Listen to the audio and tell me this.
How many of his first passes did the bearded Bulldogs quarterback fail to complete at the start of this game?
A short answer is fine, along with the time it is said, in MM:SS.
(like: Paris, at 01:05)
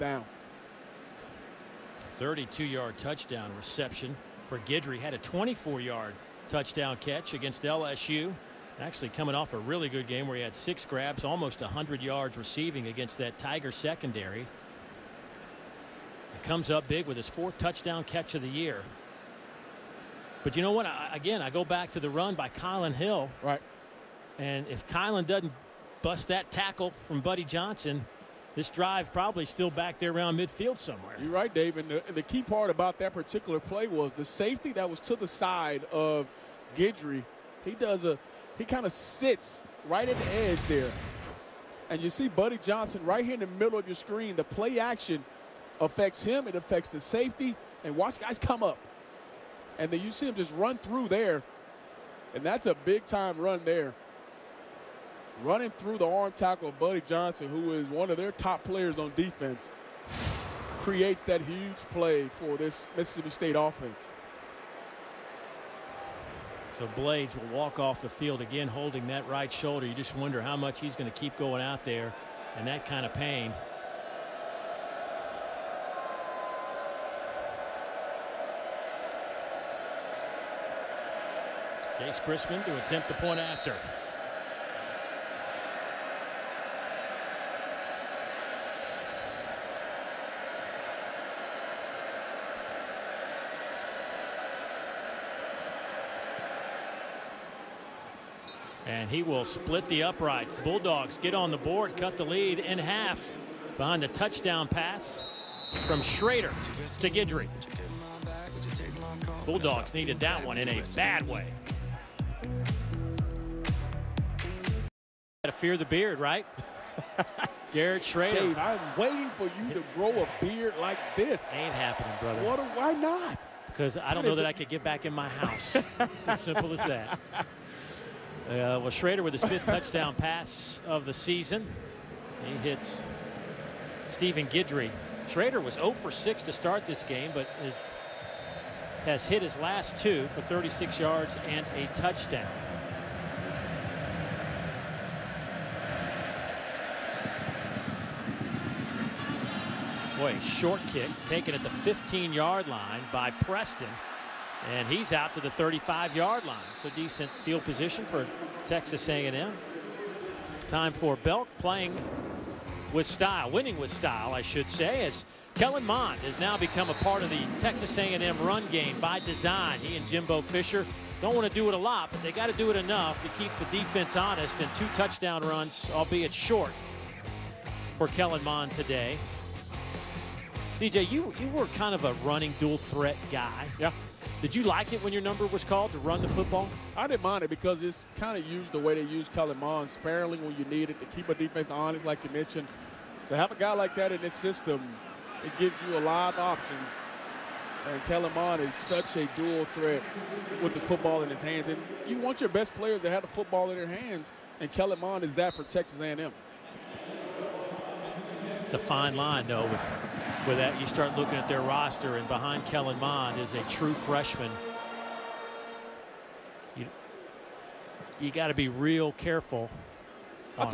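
6, at 02:15.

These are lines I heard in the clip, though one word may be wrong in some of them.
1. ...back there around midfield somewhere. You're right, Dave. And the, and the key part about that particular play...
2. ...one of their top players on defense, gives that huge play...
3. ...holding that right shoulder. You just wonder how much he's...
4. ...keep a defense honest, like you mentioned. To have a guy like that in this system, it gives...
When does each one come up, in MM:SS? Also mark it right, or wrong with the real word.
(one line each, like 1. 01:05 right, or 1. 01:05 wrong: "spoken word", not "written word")
1. 00:29 right
2. 00:57 wrong: "creates", not "gives"
3. 01:08 right
4. 03:11 right.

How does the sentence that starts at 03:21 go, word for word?
And you want your best players to have the football in their hands, and Kellen Mond is that for Texas A&M.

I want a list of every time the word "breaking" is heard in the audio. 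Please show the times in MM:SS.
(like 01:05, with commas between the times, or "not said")
not said.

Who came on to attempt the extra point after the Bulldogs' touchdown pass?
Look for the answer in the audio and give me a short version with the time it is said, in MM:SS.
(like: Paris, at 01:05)
Chase Crispin, at 01:21.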